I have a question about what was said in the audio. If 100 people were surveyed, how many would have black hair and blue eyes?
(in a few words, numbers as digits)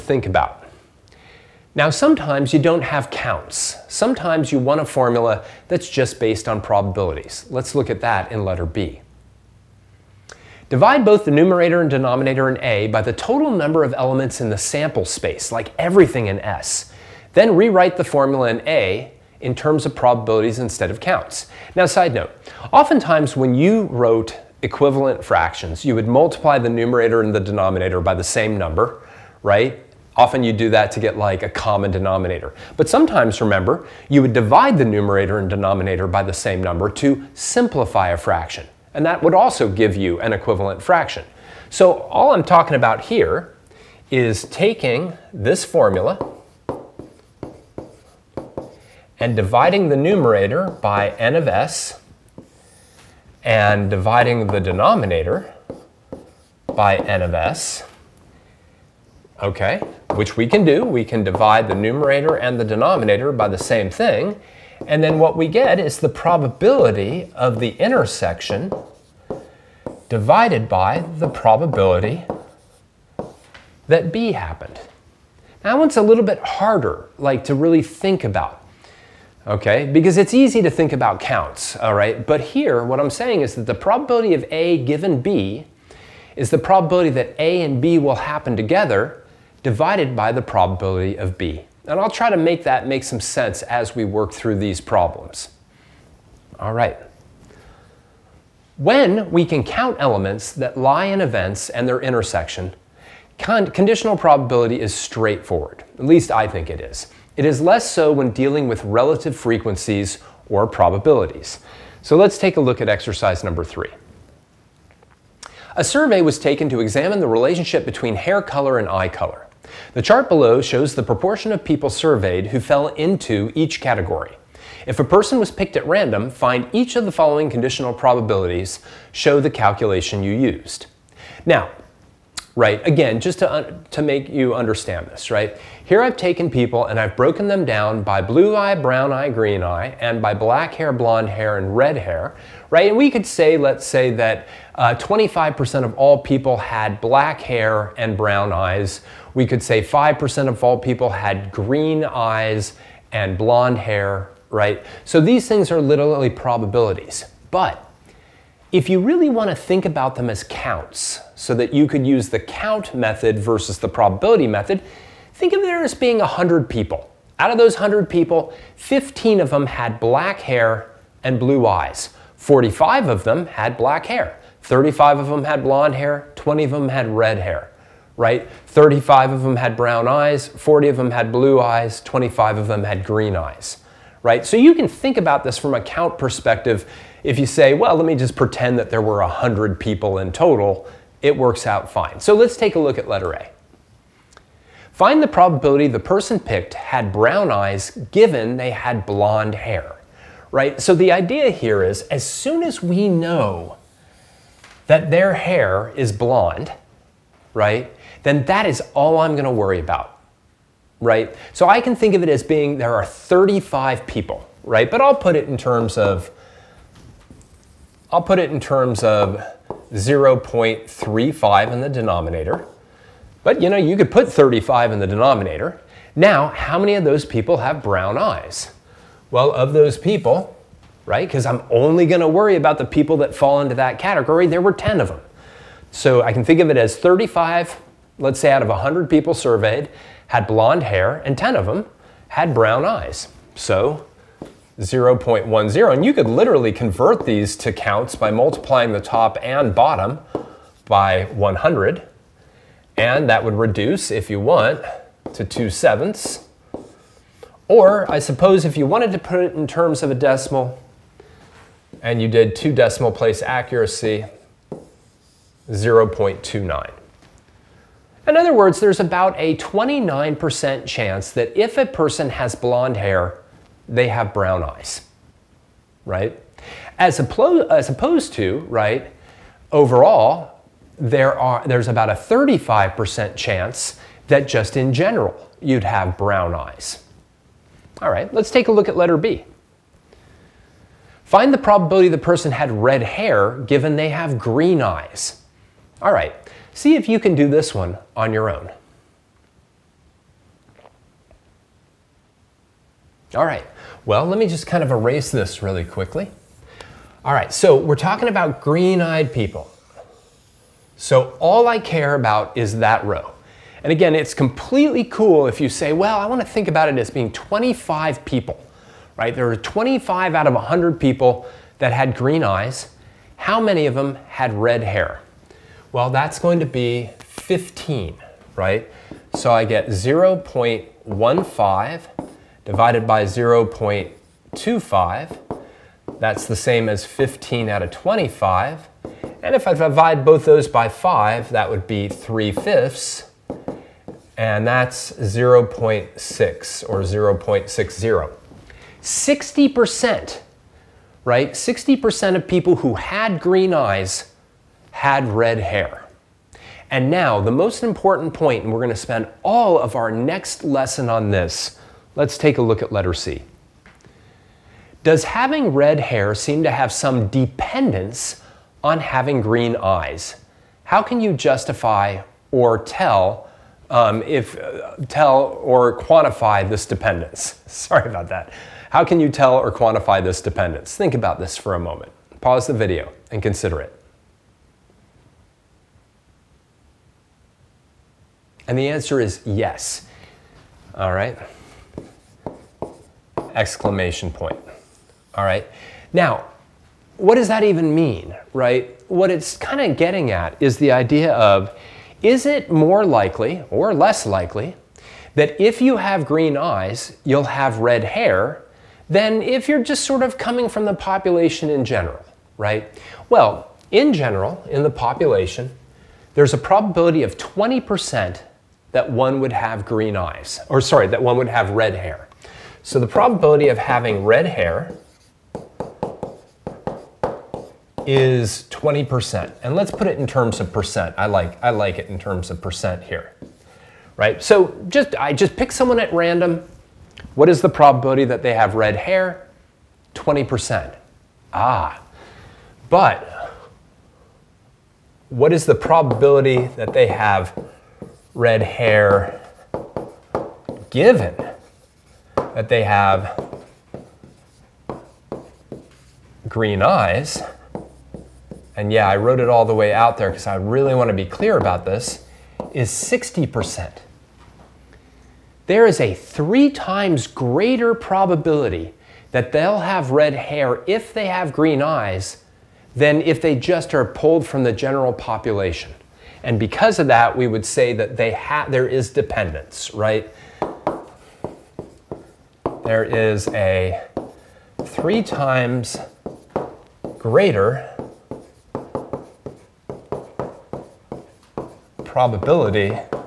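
15.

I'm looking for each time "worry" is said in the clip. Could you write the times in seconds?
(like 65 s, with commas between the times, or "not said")
209 s, 232 s.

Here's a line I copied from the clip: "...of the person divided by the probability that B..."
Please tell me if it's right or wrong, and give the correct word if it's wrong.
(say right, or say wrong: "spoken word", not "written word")
wrong: "intersection", not "person".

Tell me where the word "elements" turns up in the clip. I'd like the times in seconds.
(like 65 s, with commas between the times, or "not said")
13 s, 99 s.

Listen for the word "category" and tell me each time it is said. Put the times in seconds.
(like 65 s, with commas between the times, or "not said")
123 s, 233 s.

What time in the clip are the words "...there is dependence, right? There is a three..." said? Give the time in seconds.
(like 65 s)
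478 s.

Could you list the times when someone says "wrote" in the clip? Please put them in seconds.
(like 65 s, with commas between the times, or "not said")
23 s, 459 s.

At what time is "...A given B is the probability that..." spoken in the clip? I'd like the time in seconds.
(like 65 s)
84 s.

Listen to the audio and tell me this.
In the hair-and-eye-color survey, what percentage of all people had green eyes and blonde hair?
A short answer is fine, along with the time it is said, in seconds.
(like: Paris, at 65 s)
5%, at 149 s.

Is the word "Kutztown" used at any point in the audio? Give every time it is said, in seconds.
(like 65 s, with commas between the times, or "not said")
not said.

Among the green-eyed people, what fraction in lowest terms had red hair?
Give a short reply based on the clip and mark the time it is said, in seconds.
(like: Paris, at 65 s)
3/5, at 342 s.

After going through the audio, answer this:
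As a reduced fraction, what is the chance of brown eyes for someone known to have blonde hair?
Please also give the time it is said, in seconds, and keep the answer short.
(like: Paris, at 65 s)
2/7, at 255 s.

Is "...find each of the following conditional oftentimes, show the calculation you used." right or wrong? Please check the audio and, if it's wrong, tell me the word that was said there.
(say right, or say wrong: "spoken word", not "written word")
wrong: "probabilities", not "oftentimes".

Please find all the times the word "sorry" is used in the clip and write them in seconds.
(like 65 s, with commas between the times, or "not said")
377 s, 420 s.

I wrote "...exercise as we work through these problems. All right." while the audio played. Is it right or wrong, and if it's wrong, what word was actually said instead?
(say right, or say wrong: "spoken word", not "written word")
wrong: "sense", not "exercise".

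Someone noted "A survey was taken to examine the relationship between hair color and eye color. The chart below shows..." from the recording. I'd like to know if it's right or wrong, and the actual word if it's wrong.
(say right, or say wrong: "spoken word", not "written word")
right.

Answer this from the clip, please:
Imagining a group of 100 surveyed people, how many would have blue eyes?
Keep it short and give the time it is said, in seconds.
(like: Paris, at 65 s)
40, at 180 s.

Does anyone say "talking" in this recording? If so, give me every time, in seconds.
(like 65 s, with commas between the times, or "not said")
42 s, 307 s.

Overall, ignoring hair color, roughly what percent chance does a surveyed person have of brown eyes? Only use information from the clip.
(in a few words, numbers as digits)
35%.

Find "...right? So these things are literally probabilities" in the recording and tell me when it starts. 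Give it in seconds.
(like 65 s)
154 s.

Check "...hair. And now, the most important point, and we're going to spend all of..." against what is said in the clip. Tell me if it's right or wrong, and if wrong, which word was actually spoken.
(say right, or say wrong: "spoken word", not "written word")
right.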